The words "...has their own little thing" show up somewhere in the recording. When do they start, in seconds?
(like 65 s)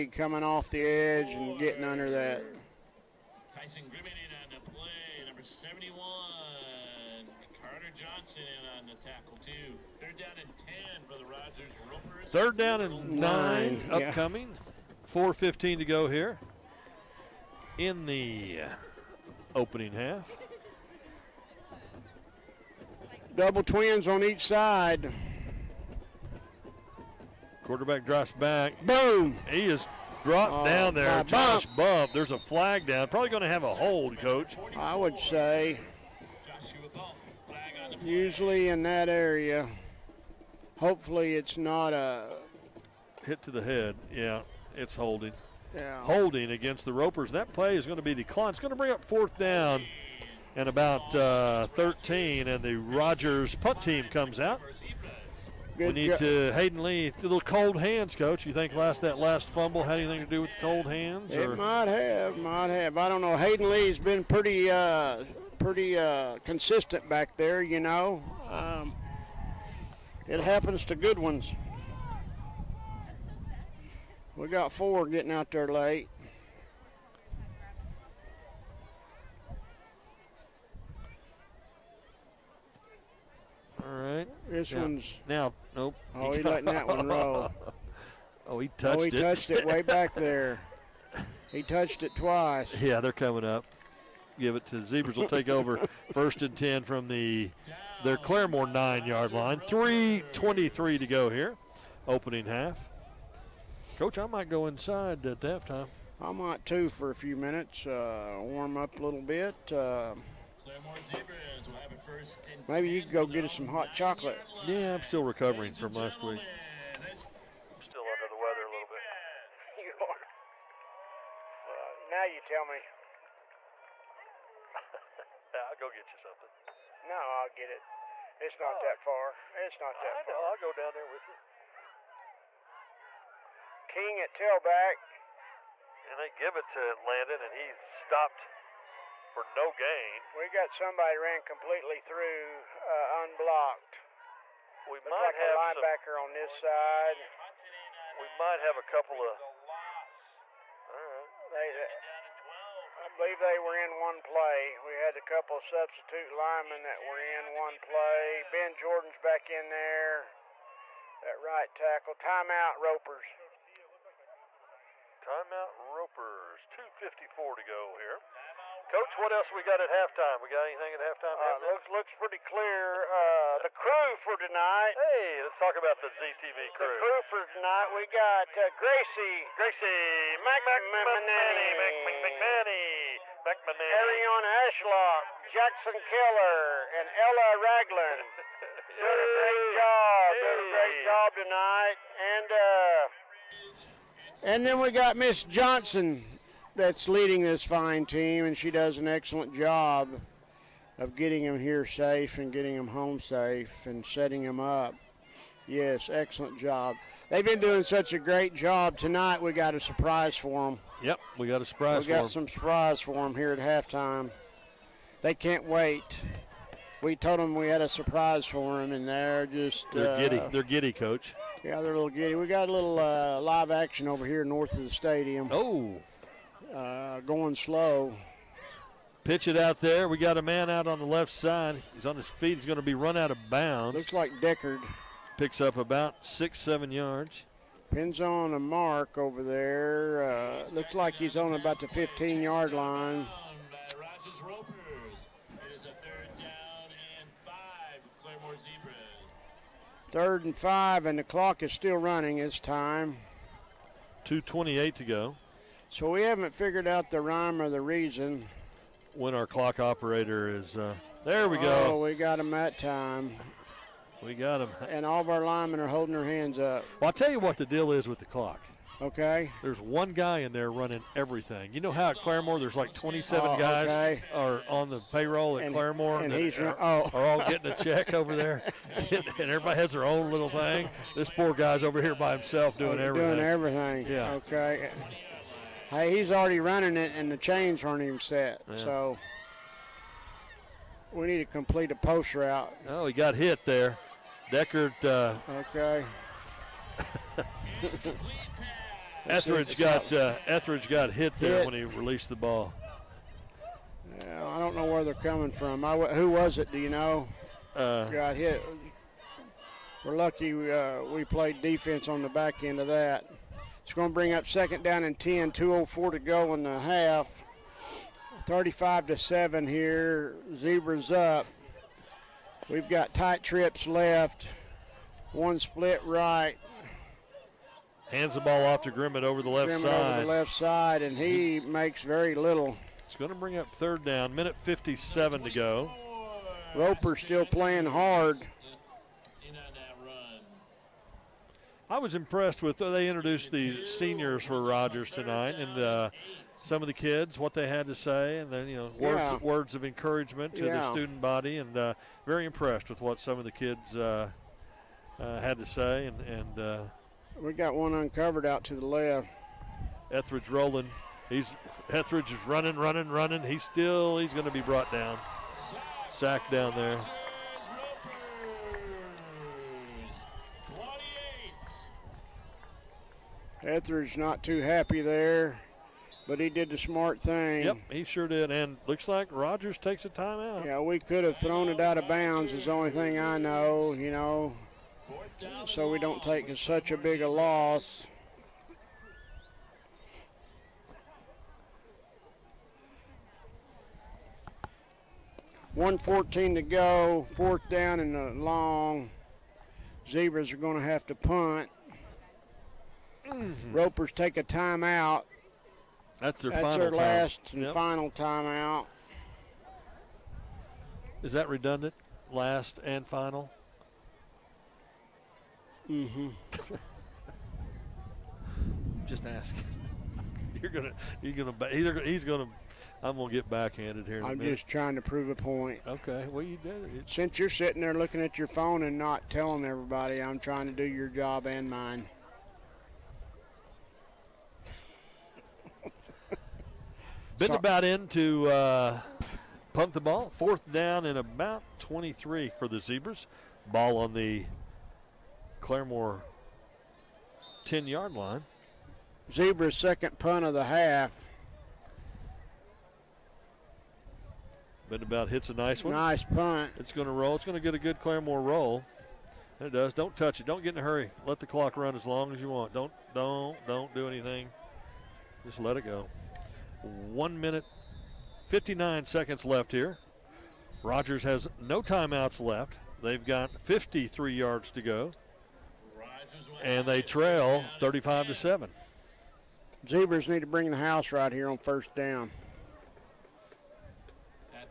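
279 s.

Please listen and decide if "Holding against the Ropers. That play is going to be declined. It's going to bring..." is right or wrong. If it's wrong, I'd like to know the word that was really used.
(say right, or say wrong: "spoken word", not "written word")
right.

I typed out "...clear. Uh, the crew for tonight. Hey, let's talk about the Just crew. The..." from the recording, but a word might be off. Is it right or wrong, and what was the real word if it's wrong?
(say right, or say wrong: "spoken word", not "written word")
wrong: "ZTV", not "Just".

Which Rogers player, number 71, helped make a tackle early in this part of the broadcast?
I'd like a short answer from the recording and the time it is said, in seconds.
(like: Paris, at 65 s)
Carter Johnson, at 7 s.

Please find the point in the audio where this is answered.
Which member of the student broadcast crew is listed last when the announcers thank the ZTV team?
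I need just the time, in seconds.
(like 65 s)
187 s.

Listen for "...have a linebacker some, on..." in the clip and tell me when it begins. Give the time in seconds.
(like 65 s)
145 s.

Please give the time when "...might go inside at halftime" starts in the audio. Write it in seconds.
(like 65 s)
104 s.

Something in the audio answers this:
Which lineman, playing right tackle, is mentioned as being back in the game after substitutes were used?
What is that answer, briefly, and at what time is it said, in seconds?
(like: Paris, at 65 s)
Ben Jordan, at 158 s.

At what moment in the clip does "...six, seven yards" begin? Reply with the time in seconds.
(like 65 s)
236 s.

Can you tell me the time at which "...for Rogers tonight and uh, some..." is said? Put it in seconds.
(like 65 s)
344 s.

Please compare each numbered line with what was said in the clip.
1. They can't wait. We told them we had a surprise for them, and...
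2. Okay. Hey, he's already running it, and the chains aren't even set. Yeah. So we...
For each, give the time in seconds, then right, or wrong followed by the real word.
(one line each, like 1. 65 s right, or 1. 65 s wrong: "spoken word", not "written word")
1. 215 s right
2. 284 s right.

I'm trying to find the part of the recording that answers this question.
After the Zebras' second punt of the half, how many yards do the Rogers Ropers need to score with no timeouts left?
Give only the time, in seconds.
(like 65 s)
473 s.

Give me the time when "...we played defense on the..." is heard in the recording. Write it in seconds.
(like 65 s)
311 s.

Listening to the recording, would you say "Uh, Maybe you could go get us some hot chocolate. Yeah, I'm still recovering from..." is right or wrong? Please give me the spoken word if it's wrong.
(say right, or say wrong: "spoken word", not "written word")
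right.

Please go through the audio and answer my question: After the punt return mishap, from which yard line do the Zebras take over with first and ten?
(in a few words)
9.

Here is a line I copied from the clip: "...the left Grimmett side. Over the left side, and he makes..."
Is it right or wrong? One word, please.
right.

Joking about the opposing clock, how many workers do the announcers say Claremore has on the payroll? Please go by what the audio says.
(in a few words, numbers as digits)
27.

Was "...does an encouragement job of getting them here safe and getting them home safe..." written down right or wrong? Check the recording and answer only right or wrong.
wrong.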